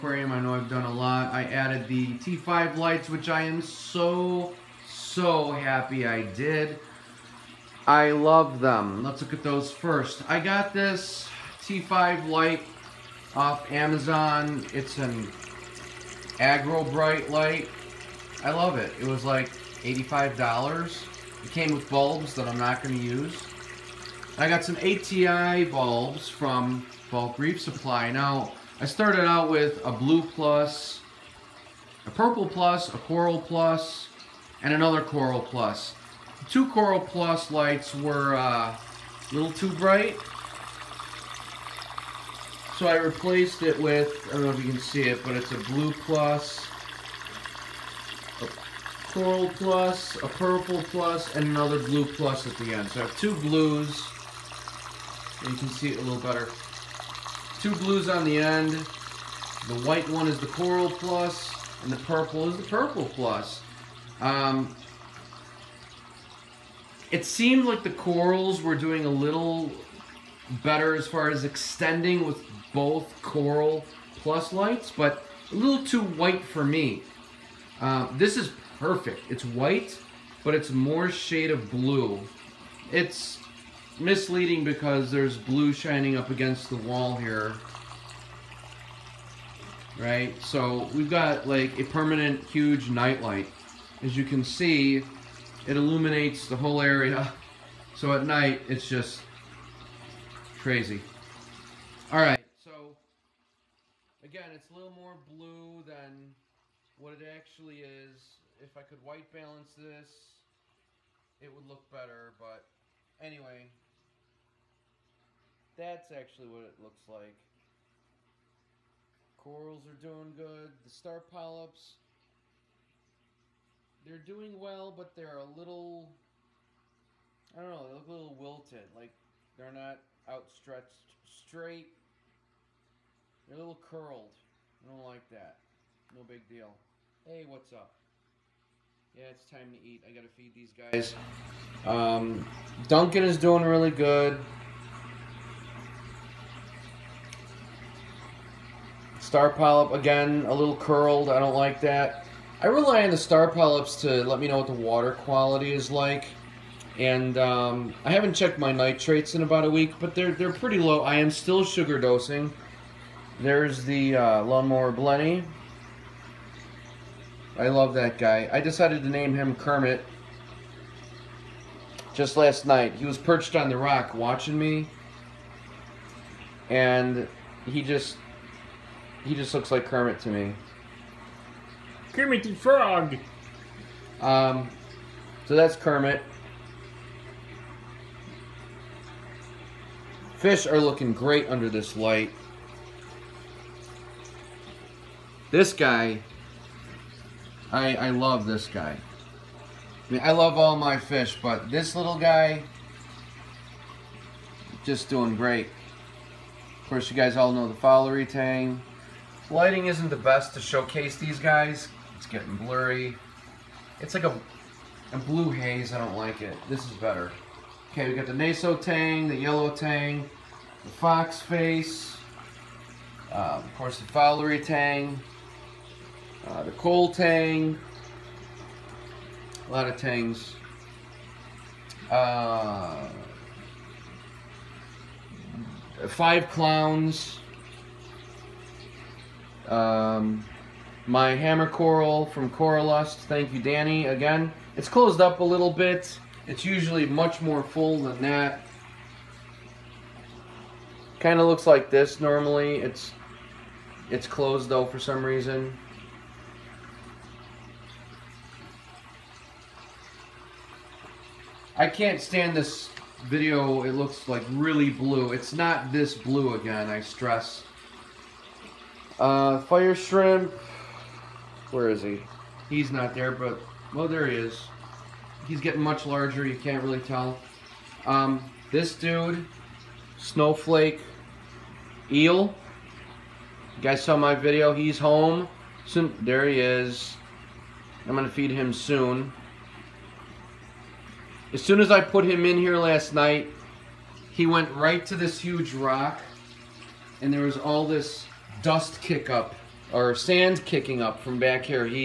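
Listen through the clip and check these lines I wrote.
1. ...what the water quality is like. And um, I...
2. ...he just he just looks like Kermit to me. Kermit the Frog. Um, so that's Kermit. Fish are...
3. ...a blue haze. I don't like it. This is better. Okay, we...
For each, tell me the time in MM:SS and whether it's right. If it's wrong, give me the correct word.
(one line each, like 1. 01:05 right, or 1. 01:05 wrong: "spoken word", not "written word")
1. 02:34 right
2. 02:57 right
3. 03:35 right.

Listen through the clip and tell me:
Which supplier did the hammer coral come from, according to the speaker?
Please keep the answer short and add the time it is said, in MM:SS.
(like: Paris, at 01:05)
Coralust, at 04:02.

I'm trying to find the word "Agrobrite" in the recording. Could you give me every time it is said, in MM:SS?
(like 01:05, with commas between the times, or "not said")
00:16.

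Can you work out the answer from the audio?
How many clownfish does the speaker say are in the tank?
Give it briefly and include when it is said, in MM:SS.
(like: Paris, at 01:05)
5, at 03:56.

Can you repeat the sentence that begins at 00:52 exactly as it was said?
So I have two blues, and you can see it a little better.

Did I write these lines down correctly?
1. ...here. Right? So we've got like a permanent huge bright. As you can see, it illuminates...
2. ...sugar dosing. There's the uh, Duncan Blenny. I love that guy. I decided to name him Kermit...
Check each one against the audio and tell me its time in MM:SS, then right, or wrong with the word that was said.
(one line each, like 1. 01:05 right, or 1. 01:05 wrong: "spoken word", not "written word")
1. 01:27 wrong: "nightlight", not "bright"
2. 02:41 wrong: "Lawnmower", not "Duncan".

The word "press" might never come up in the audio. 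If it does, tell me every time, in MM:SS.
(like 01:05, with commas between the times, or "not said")
not said.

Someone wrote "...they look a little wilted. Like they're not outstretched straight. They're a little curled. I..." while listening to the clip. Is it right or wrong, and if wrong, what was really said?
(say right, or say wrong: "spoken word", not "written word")
right.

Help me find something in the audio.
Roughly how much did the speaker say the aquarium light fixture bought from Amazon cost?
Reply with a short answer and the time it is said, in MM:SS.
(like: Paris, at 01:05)
$85, at 00:19.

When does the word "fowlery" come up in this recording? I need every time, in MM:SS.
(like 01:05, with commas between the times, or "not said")
03:27, 03:44.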